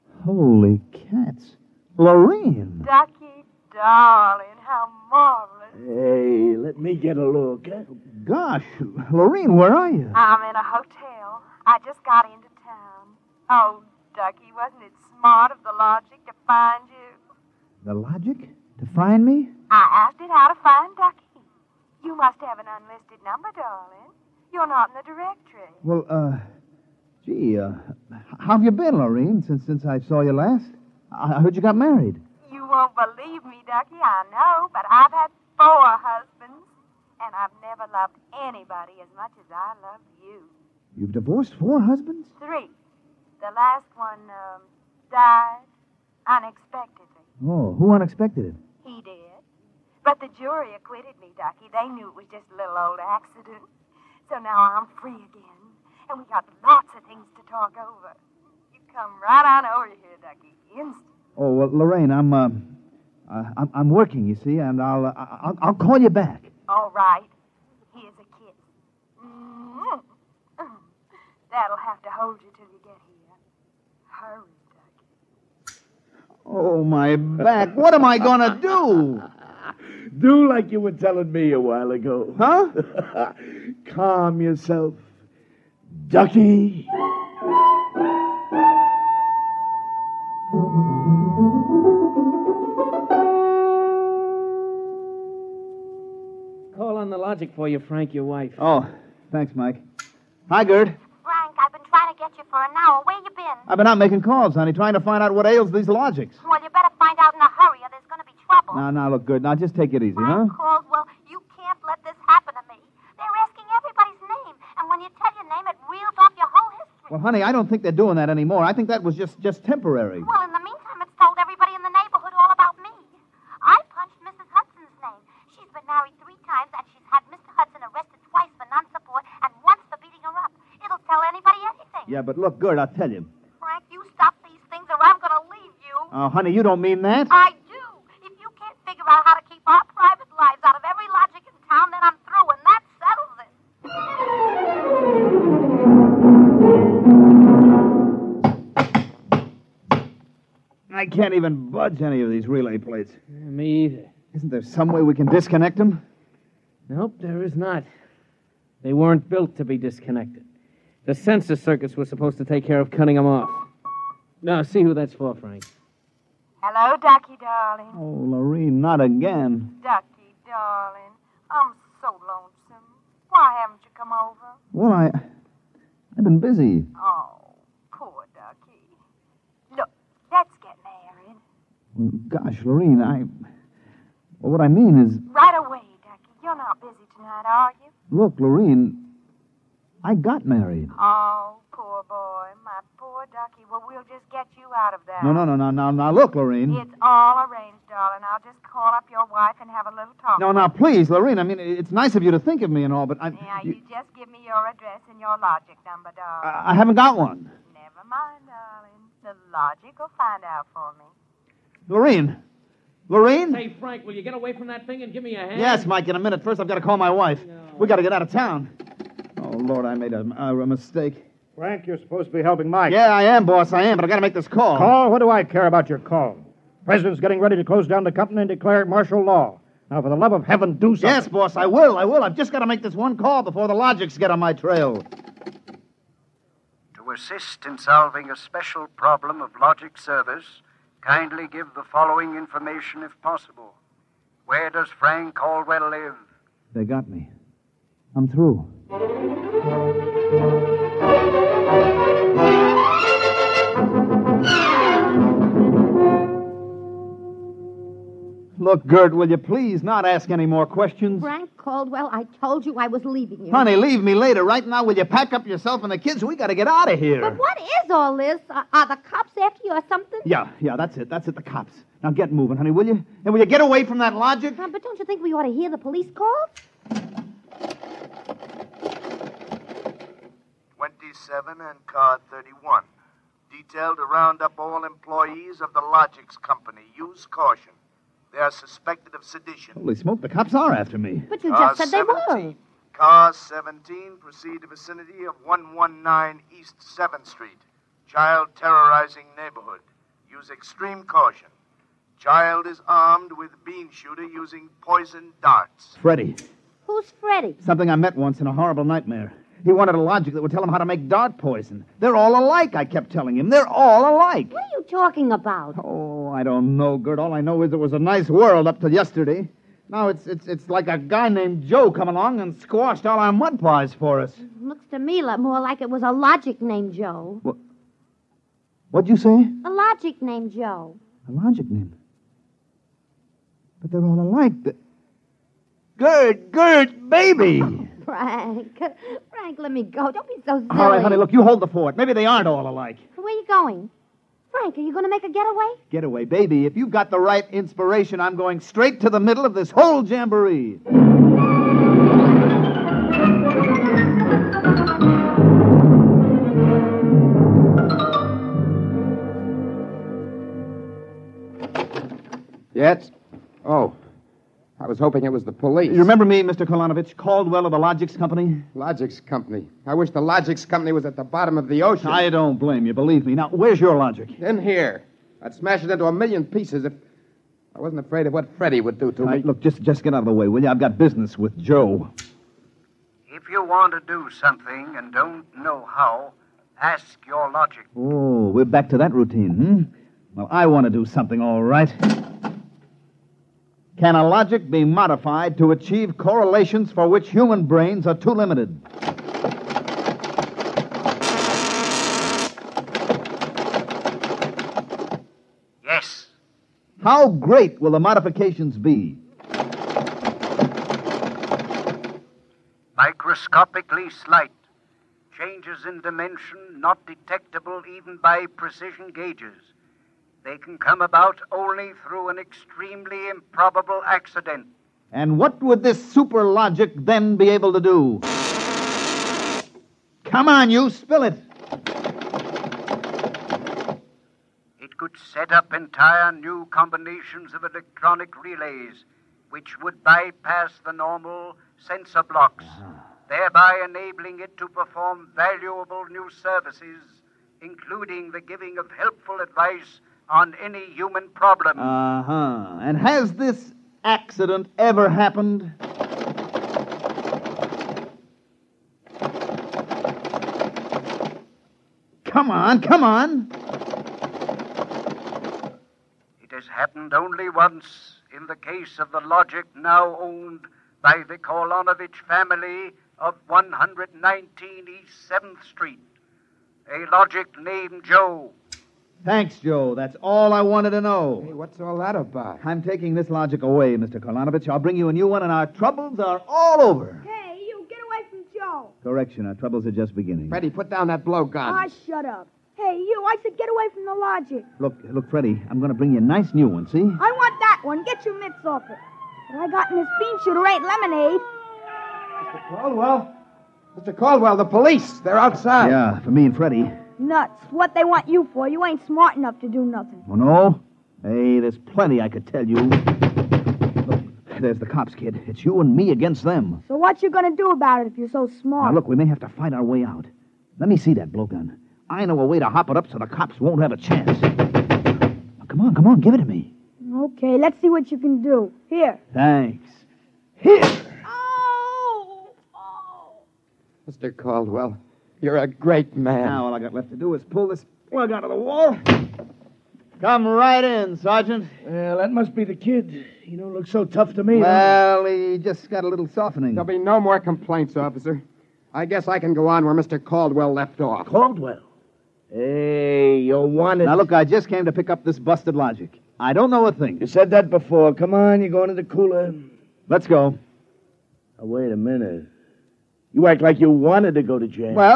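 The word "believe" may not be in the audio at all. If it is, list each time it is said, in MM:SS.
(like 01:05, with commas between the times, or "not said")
00:32, 06:12.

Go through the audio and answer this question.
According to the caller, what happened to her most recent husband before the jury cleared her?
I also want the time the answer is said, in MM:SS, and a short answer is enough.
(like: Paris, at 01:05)
died unexpectedly, at 00:45.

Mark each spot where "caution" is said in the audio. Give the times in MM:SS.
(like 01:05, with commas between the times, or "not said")
04:47, 05:01.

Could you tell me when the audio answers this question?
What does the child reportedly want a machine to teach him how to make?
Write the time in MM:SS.
05:11.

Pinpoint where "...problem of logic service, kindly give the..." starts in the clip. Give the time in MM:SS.
03:58.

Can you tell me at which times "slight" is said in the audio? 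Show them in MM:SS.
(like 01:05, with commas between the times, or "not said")
06:54.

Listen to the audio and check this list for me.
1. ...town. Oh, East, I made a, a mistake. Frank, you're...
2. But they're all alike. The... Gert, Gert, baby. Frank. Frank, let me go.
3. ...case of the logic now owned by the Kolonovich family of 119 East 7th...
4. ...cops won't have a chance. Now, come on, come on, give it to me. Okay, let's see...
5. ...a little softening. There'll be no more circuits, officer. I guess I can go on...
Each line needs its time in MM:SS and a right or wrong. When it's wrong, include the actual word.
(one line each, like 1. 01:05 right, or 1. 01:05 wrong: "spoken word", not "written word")
1. 03:38 wrong: "Lord", not "East"
2. 05:33 right
3. 07:48 right
4. 08:43 right
5. 09:06 wrong: "complaints", not "circuits".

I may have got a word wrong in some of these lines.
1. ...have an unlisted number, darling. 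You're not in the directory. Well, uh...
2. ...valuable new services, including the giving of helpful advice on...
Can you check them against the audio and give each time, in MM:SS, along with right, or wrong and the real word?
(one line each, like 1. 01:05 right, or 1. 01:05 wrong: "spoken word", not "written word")
1. 00:22 right
2. 07:25 right.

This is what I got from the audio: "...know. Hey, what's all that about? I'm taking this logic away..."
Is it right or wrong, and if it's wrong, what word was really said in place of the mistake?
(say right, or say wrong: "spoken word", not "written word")
right.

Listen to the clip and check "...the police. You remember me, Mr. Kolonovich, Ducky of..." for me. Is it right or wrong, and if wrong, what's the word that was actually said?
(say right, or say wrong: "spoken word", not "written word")
wrong: "Caldwell", not "Ducky".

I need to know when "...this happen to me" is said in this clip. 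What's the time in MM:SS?
01:52.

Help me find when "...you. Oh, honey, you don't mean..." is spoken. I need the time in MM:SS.
02:15.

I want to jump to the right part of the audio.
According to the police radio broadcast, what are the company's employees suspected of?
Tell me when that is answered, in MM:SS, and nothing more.
04:49.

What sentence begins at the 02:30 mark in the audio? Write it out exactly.
I can't even budge any of these relay plates.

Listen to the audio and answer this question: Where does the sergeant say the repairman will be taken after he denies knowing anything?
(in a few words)
the cooler.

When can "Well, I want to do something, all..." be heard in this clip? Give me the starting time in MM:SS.
06:30.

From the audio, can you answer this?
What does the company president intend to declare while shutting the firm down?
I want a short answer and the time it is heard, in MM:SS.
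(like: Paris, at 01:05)
martial law, at 03:48.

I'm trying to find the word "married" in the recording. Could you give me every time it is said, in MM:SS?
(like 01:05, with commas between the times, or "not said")
00:31, 03:00, 03:10.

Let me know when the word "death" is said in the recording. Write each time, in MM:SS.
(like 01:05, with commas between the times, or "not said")
not said.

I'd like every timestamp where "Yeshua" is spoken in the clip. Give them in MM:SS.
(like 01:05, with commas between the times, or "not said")
not said.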